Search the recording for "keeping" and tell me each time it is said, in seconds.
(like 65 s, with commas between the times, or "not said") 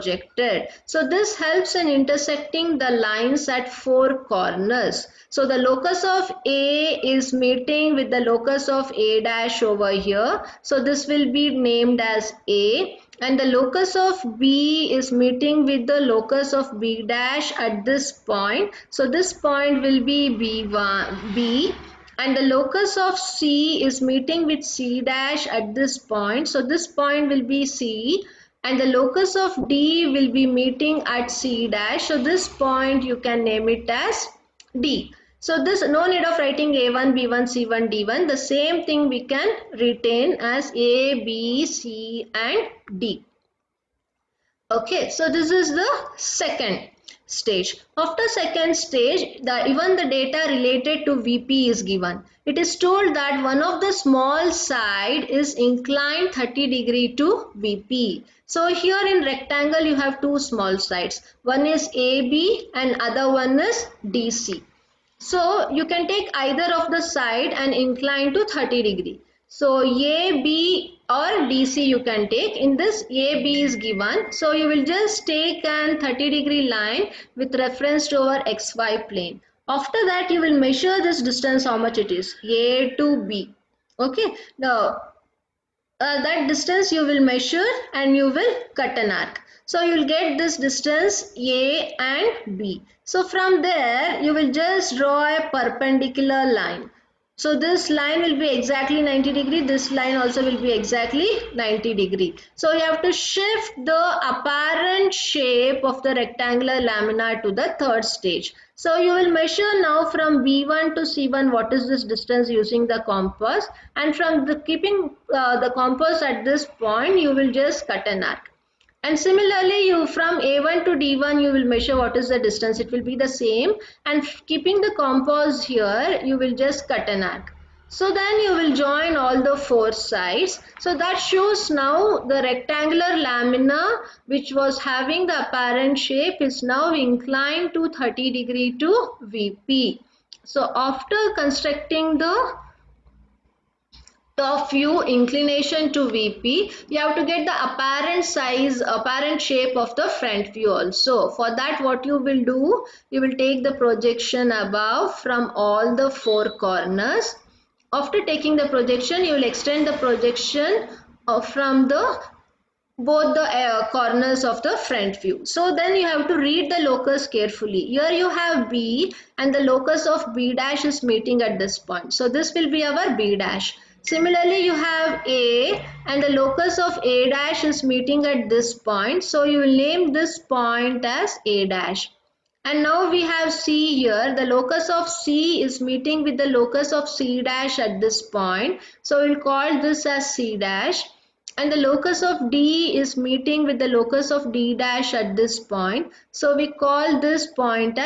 114 s, 124 s.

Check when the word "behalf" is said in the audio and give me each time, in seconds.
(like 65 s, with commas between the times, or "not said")
not said.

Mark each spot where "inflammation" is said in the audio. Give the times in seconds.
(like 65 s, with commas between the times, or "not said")
not said.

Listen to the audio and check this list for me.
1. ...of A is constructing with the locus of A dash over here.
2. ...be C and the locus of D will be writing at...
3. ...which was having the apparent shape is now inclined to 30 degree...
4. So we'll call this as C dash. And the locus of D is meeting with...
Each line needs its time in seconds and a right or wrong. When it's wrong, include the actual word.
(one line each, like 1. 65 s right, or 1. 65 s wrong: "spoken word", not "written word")
1. 6 s wrong: "meeting", not "constructing"
2. 27 s wrong: "meeting", not "writing"
3. 134 s right
4. 189 s right.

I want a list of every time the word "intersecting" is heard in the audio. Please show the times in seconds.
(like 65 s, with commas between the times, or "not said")
1 s.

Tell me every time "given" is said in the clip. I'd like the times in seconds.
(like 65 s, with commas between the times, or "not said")
51 s, 73 s.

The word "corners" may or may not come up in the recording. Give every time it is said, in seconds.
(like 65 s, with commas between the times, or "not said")
4 s, 156 s, 163 s.